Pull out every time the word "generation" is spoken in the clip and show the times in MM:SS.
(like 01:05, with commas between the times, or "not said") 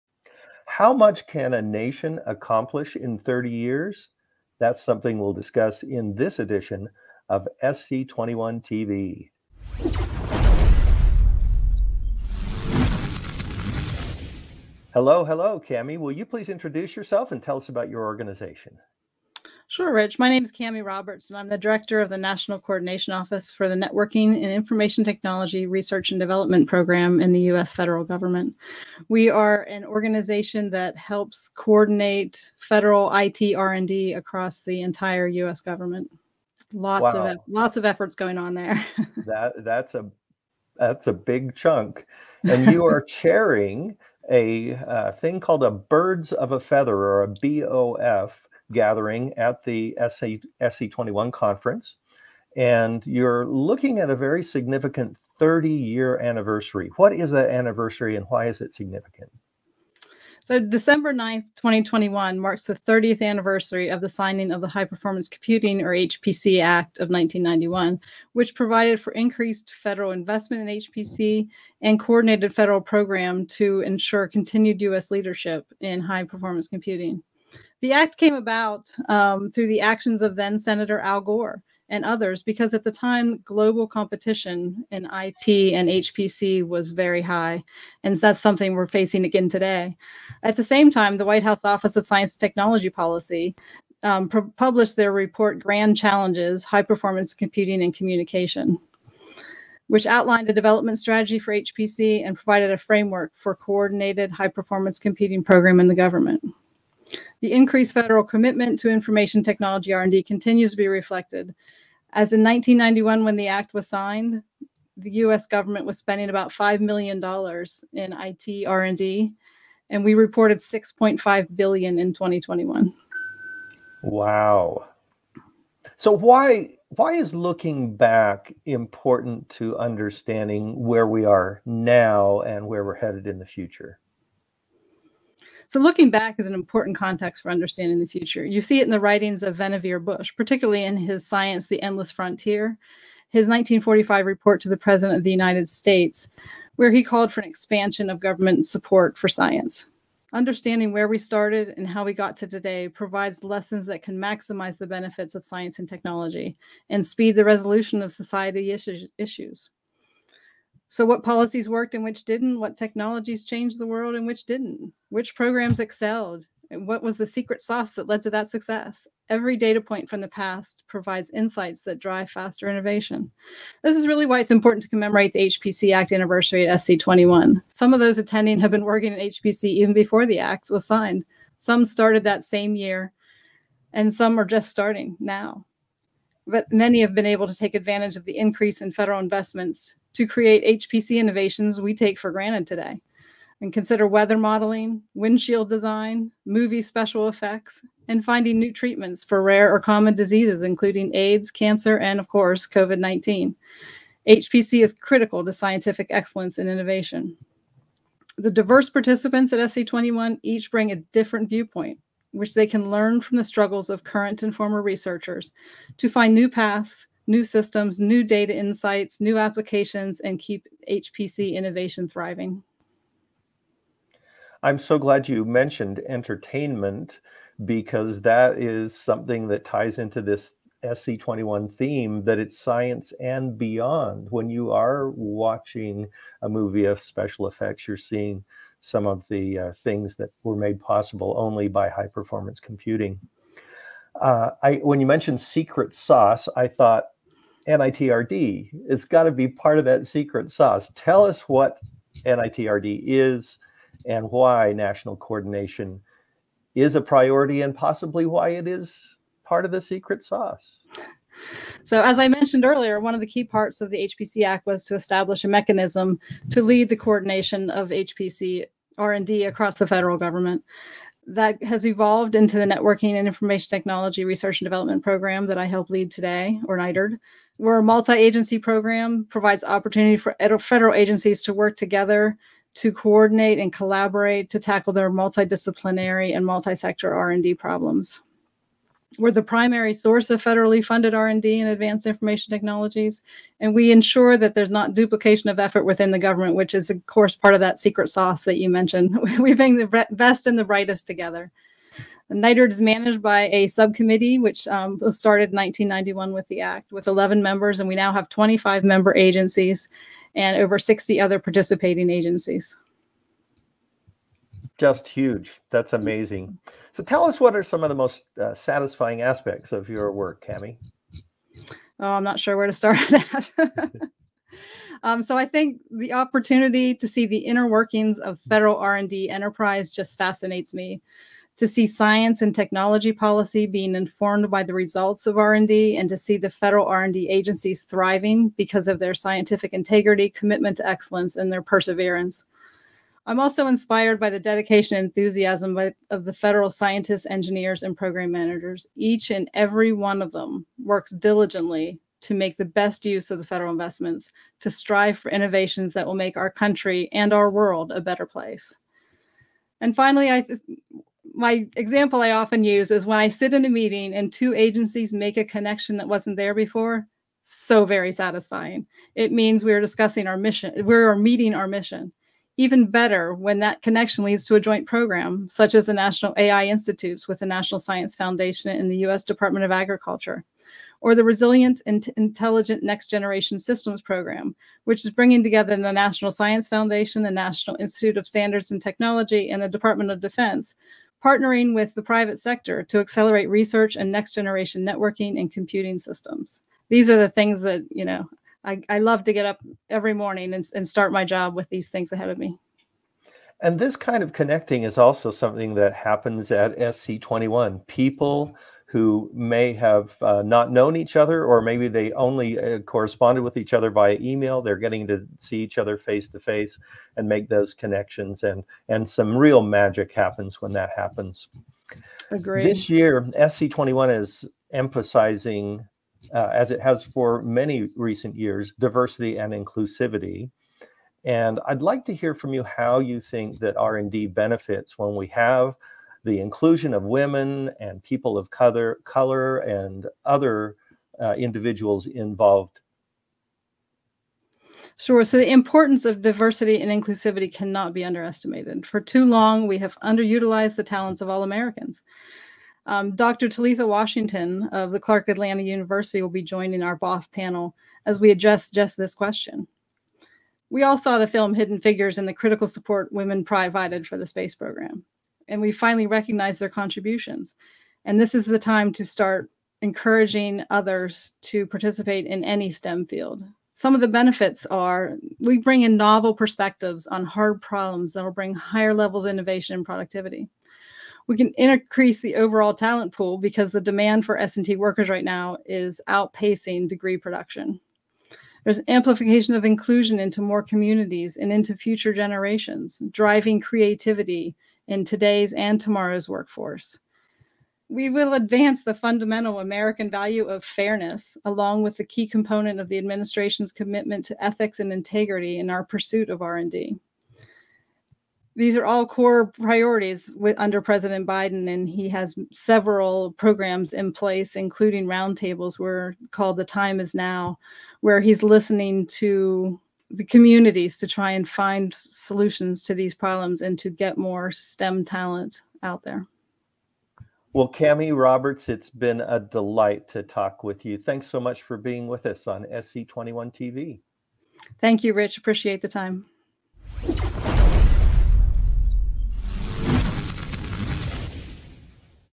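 06:23, 06:34, 08:12.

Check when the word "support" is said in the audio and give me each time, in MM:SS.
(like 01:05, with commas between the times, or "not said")
02:28, 07:42.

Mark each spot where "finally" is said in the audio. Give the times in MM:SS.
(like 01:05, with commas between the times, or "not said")
05:59, 07:45.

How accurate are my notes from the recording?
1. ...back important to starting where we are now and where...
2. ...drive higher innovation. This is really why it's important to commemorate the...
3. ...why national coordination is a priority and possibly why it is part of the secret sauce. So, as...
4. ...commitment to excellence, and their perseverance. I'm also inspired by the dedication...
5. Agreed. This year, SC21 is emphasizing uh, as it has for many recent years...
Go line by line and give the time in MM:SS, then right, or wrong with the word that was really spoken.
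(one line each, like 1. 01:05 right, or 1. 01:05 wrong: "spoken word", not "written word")
1. 02:07 wrong: "understanding", not "starting"
2. 02:51 wrong: "faster", not "higher"
3. 04:14 right
4. 05:40 right
5. 07:02 right.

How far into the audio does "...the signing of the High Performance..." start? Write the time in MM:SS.
01:04.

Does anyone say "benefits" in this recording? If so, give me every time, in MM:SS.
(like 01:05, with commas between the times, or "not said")
02:34, 07:14, 07:54.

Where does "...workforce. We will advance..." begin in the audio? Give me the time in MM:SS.
08:16.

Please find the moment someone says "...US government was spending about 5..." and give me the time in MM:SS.
01:55.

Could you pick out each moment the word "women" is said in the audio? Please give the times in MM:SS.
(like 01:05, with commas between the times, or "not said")
07:17, 07:43.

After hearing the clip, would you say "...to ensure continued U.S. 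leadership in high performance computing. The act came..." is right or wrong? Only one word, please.
right.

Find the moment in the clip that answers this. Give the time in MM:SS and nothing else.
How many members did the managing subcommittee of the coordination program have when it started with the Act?
05:07.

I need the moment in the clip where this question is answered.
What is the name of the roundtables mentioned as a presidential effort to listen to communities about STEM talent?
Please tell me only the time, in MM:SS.
08:36.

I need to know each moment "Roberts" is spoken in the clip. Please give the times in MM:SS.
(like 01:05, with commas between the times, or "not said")
00:20, 08:48.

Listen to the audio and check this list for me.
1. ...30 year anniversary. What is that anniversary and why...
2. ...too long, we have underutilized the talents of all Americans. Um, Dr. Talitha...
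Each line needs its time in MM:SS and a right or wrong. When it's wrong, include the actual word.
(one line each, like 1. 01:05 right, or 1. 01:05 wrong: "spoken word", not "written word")
1. 00:55 right
2. 07:29 right.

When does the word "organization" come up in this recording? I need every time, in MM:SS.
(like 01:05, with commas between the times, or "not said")
00:18, 00:29.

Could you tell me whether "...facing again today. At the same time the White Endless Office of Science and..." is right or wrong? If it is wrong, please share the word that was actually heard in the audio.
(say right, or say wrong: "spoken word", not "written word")
wrong: "House", not "Endless".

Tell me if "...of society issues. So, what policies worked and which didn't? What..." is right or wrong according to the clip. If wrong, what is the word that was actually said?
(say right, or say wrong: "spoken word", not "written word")
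right.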